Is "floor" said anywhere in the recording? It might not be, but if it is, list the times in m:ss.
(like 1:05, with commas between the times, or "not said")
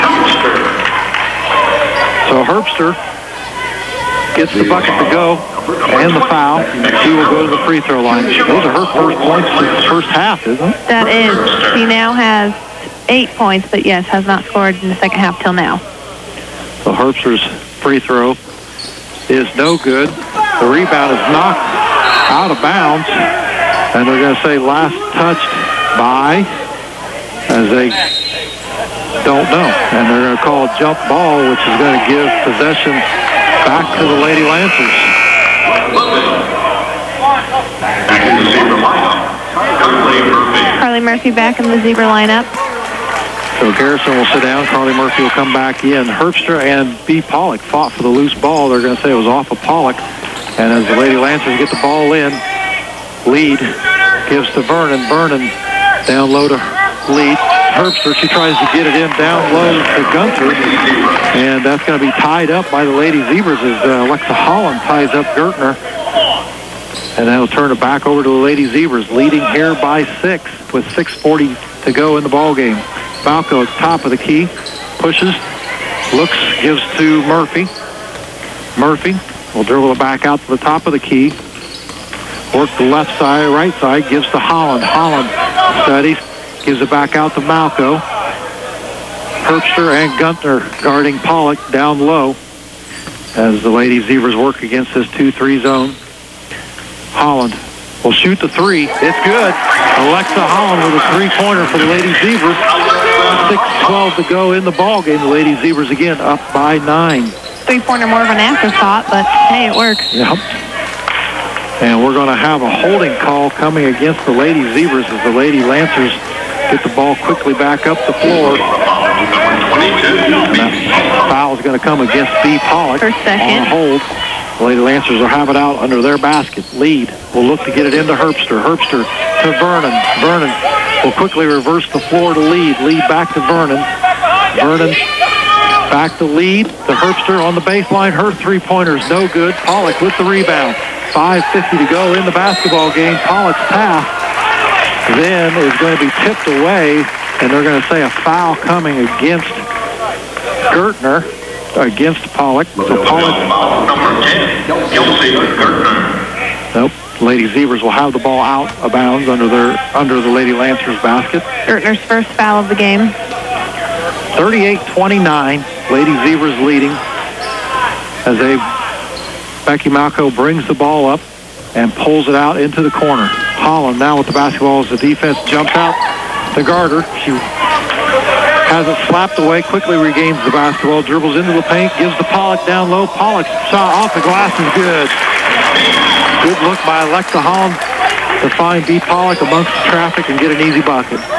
1:58, 2:12.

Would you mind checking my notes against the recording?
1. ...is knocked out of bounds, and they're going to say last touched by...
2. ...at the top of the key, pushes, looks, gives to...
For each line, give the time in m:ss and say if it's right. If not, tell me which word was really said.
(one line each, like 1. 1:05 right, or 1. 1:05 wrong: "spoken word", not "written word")
1. 0:21 right
2. 1:13 right.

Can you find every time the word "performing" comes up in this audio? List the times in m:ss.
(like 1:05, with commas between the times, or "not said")
not said.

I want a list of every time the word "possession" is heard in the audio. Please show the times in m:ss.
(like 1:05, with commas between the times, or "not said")
0:32.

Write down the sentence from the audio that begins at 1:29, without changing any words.
Herbster and Gunther guarding Pollock down low as the Lady Zebras work against this 2-3 zone.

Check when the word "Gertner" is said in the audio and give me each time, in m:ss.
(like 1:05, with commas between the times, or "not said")
1:05, 2:30, 2:35, 2:41.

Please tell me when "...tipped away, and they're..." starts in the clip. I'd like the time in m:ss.
2:26.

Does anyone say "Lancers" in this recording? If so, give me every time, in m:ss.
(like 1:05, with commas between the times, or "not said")
0:34, 0:51, 1:55, 2:04, 2:40.